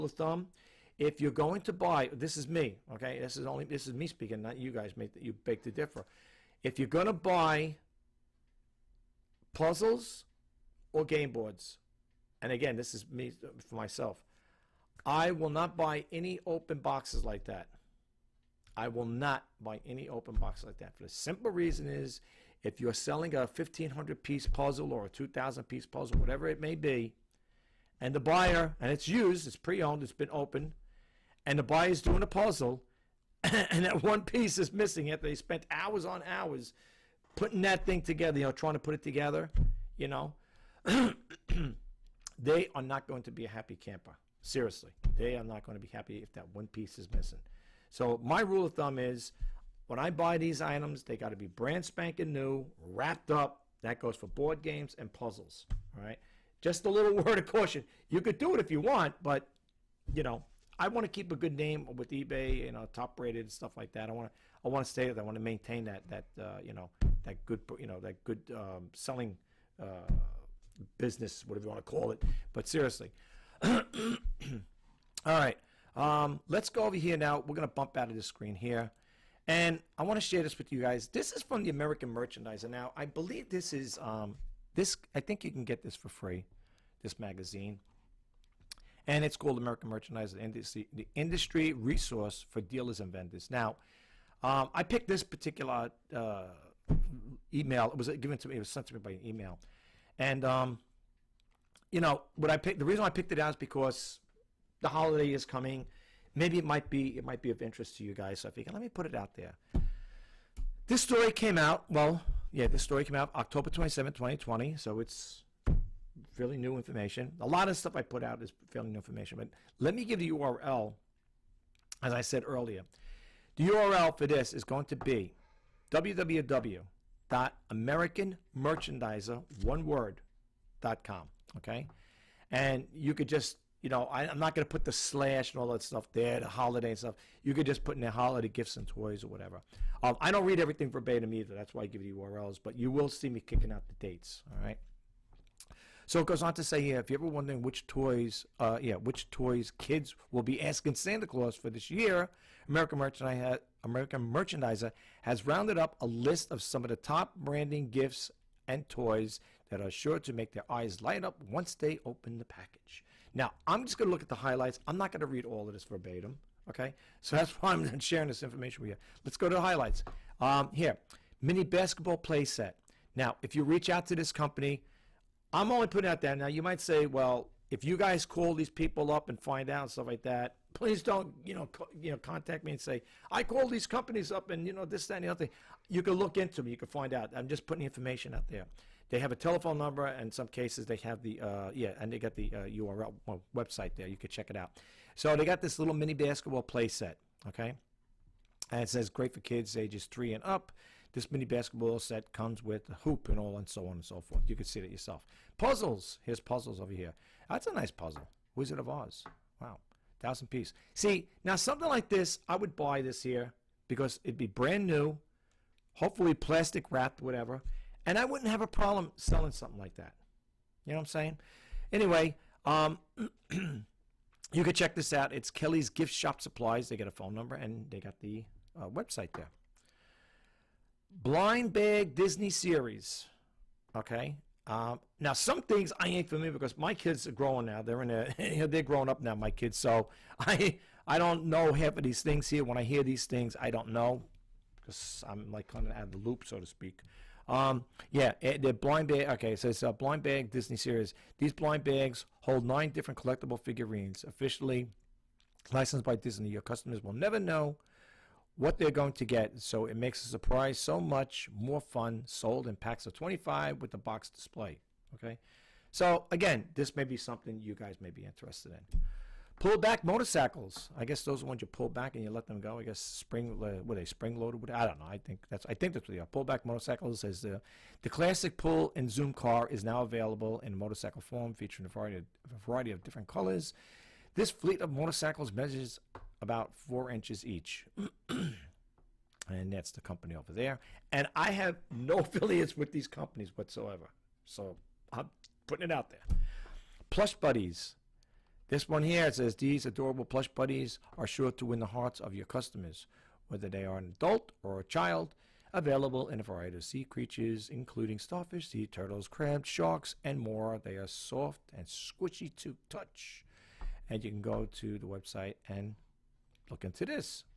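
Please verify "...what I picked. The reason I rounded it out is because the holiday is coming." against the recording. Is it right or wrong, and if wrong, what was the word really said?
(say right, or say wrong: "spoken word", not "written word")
wrong: "picked", not "rounded".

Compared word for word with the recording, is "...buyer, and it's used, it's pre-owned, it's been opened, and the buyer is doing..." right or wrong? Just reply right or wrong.
right.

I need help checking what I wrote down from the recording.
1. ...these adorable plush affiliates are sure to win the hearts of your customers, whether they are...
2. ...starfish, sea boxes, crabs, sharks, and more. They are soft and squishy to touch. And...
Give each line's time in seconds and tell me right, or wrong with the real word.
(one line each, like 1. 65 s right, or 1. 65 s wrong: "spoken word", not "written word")
1. 299 s wrong: "buddies", not "affiliates"
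2. 308 s wrong: "turtles", not "boxes".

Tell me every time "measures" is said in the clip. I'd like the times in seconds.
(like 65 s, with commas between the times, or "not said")
285 s.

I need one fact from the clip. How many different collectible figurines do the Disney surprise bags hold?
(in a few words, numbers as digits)
9.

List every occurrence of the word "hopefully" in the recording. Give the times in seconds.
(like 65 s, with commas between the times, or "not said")
215 s.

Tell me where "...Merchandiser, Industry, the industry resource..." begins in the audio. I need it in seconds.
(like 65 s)
89 s.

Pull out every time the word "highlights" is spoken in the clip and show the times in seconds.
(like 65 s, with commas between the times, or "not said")
164 s, 169 s.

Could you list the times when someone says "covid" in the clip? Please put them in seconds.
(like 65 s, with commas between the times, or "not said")
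not said.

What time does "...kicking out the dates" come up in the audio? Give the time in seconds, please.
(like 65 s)
143 s.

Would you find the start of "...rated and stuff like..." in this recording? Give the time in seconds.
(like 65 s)
63 s.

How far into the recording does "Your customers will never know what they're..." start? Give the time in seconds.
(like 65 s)
256 s.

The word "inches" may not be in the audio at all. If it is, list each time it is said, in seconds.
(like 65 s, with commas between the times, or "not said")
287 s.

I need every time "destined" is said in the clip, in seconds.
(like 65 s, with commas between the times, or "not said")
not said.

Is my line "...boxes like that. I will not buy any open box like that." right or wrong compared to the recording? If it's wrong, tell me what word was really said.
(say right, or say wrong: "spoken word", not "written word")
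right.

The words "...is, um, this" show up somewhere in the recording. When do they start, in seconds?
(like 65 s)
83 s.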